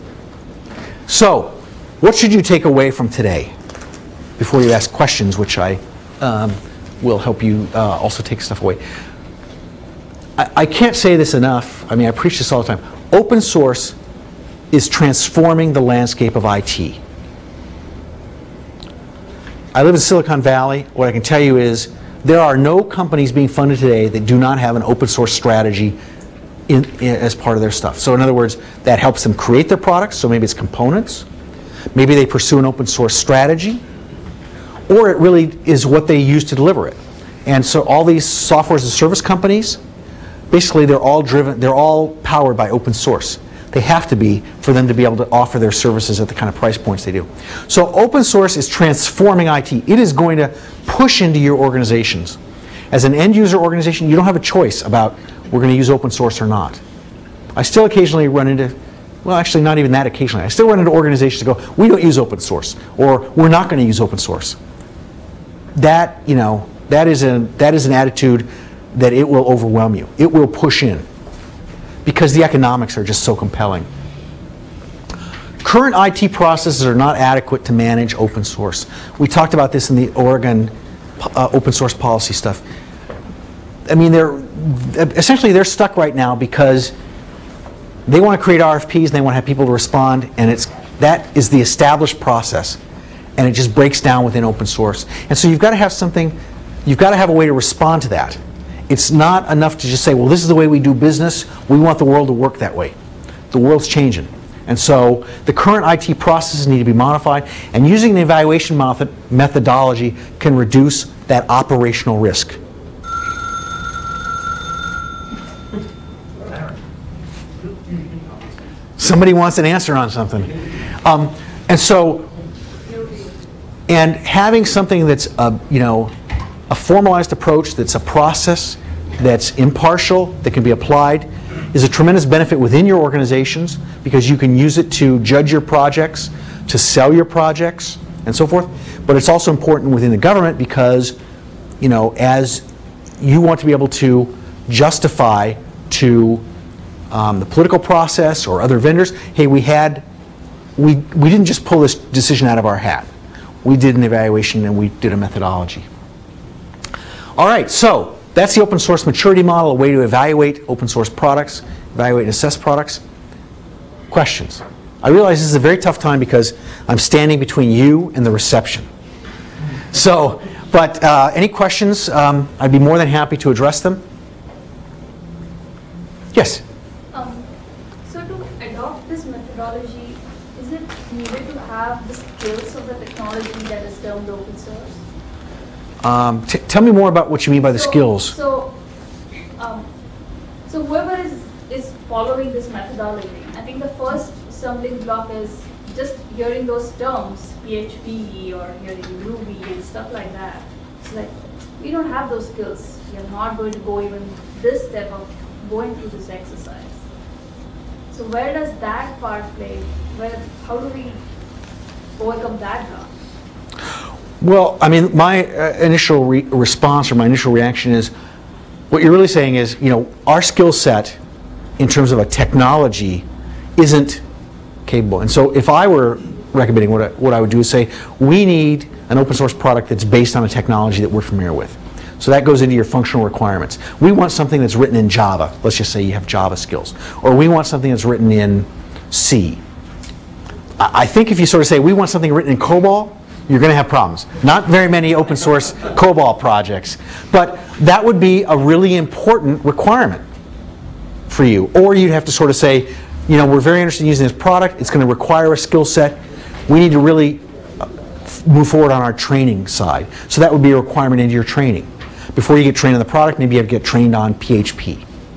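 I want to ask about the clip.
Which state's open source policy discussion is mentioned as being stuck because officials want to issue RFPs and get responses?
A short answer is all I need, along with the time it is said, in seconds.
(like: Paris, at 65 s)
Oregon, at 80 s.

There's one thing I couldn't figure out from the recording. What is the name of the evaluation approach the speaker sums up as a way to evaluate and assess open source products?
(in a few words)
open source maturity model.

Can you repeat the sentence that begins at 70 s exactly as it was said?
It will push in because the economics are just so compelling.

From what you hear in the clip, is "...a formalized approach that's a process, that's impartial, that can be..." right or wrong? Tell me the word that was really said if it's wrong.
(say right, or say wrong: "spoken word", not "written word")
right.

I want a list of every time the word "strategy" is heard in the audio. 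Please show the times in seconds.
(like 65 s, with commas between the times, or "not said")
25 s, 33 s.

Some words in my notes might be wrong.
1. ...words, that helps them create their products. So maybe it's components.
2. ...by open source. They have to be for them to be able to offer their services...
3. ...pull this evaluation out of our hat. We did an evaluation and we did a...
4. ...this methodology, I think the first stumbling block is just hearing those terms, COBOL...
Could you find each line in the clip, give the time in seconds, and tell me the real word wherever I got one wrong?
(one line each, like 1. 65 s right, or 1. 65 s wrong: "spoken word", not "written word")
1. 28 s right
2. 42 s right
3. 151 s wrong: "decision", not "evaluation"
4. 192 s wrong: "PHP", not "COBOL".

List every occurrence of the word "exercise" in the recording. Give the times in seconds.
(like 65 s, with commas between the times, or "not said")
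206 s.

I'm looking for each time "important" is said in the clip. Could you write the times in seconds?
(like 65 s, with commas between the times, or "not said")
139 s, 248 s.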